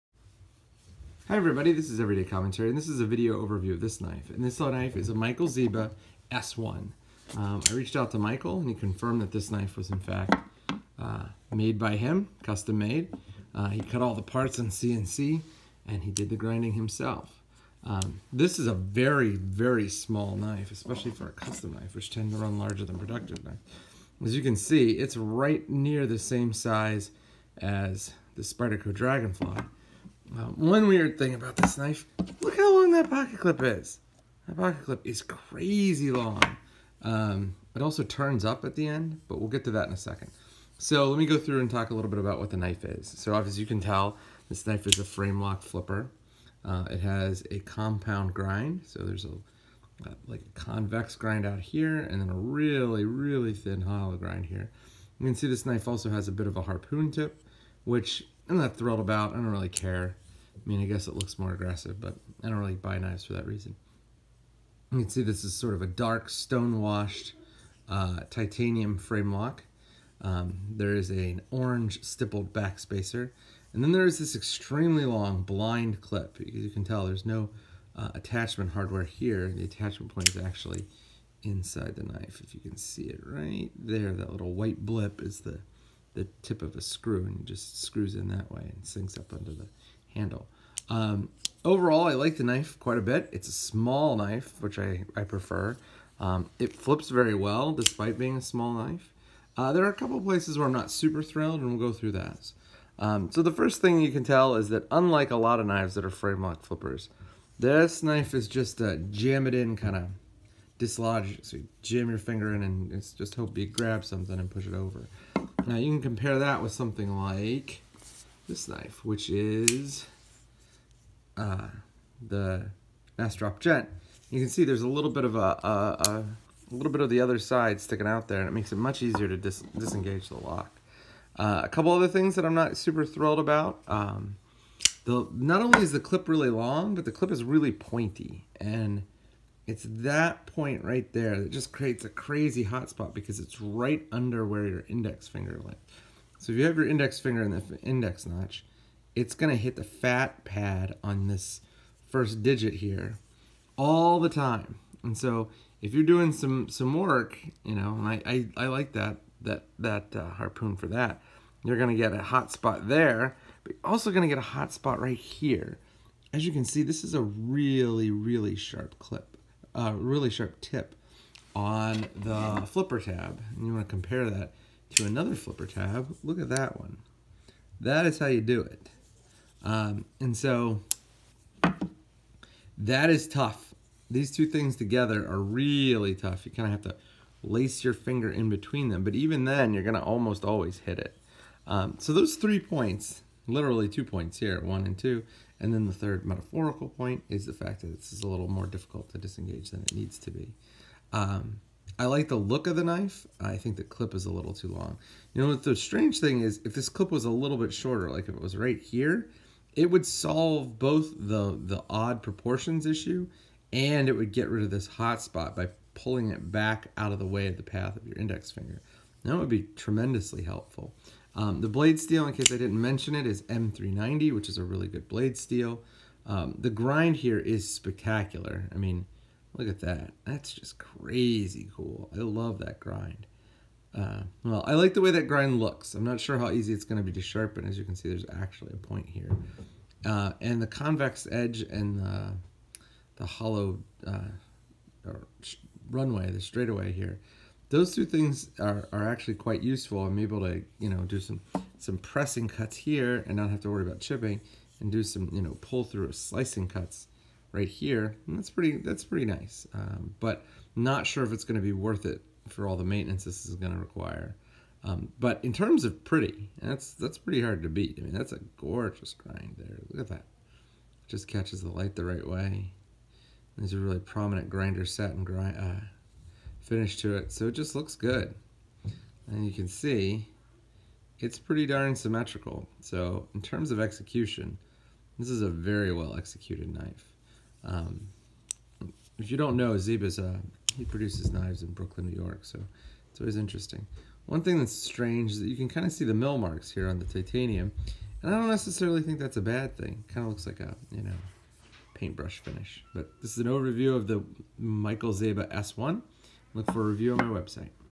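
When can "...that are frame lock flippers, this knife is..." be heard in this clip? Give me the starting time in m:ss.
1:45.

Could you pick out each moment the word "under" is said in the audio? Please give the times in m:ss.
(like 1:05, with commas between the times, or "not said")
1:29, 2:24.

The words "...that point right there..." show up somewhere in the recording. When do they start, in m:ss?
2:19.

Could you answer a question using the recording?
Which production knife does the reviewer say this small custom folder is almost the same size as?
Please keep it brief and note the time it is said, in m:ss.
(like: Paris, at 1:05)
Spyderco Dragonfly, at 0:28.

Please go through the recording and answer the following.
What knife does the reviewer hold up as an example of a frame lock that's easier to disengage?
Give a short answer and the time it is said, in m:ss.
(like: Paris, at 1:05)
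Nest Drop Jet, at 2:03.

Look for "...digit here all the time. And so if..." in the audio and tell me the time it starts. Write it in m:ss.
2:32.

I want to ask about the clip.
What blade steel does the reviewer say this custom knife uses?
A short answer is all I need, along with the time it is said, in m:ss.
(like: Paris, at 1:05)
M390, at 3:43.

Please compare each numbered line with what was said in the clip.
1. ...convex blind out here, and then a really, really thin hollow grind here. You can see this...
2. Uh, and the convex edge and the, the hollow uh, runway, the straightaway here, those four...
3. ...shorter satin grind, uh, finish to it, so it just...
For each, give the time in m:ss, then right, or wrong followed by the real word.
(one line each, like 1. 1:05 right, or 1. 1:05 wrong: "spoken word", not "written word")
1. 0:50 wrong: "grind", not "blind"
2. 4:00 wrong: "two", not "four"
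3. 4:34 wrong: "grinder", not "shorter".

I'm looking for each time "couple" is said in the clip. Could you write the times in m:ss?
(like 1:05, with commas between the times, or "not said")
1:39, 2:11.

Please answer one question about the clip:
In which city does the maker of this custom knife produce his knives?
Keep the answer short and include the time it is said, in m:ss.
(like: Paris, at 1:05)
Brooklyn, New York, at 4:51.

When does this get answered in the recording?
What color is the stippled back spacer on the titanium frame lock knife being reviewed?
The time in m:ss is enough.
1:11.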